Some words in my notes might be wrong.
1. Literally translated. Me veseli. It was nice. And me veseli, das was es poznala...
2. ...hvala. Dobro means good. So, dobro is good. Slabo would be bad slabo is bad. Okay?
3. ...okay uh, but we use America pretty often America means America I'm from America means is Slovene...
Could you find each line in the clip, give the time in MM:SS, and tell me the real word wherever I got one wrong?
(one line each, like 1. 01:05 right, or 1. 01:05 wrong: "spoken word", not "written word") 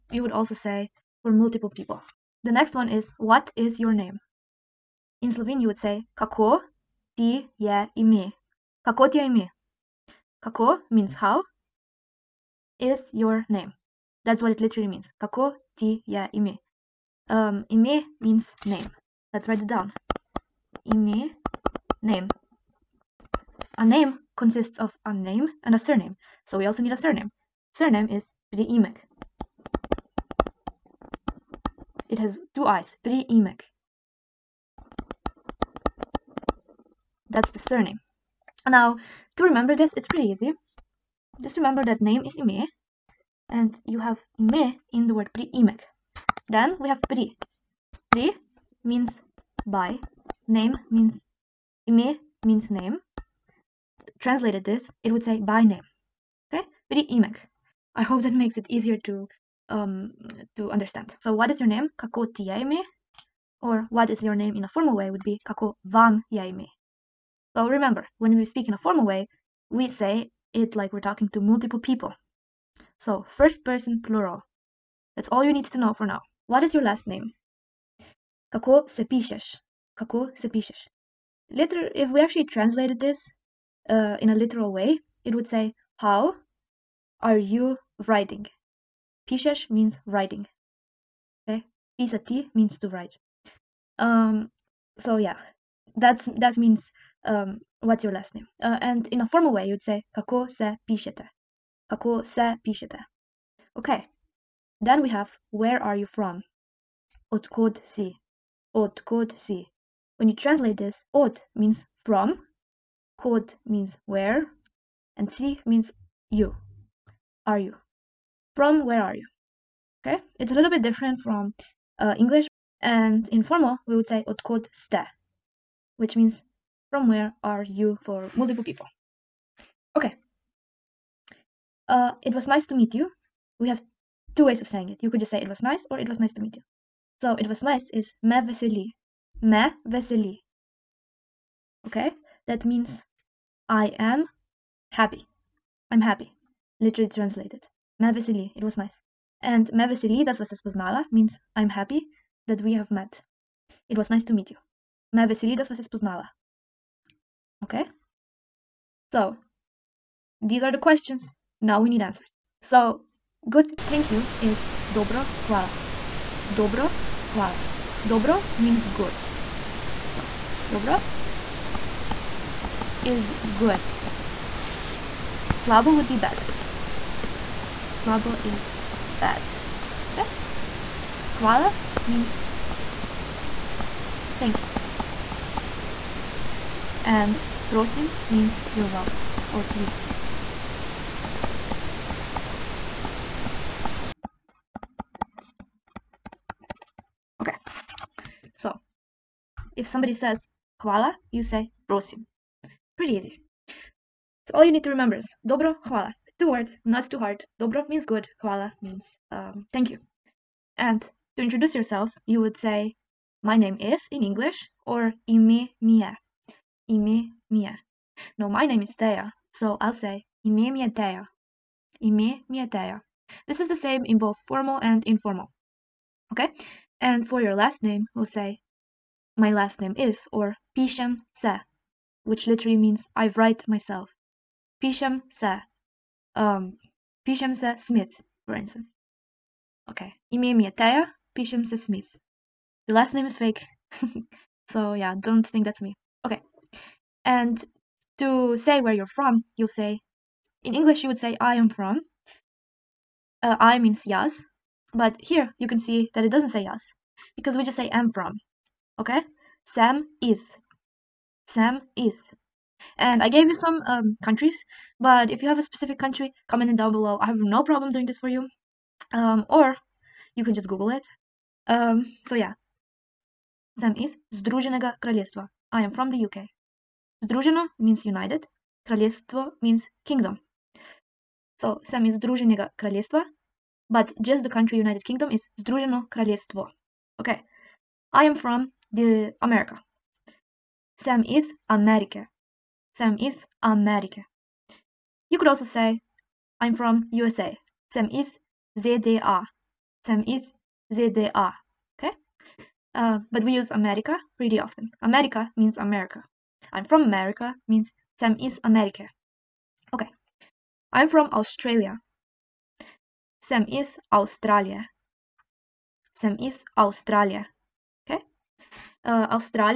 1. 02:26 right
2. 02:47 right
3. 05:01 wrong: "America", not "Slovene".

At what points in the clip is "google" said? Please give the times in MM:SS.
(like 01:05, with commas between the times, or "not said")
04:30.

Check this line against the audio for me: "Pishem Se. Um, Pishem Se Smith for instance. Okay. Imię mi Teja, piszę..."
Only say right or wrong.
right.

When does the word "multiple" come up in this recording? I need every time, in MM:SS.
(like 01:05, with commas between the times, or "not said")
00:01, 01:11, 02:08.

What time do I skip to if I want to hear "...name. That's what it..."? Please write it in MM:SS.
00:13.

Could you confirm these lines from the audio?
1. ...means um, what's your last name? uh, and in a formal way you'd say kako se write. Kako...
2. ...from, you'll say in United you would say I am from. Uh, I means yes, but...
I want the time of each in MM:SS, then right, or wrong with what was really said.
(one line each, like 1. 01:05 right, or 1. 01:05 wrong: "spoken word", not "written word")
1. 01:36 wrong: "pišete", not "write"
2. 04:09 wrong: "English", not "United".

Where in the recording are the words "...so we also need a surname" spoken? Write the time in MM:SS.
00:26.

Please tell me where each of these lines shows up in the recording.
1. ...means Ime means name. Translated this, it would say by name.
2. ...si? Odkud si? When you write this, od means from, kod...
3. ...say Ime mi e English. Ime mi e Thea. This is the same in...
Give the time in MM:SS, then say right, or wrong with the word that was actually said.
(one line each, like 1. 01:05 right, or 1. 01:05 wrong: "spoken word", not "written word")
1. 00:50 right
2. 01:47 wrong: "translate", not "write"
3. 03:39 wrong: "Thea", not "English".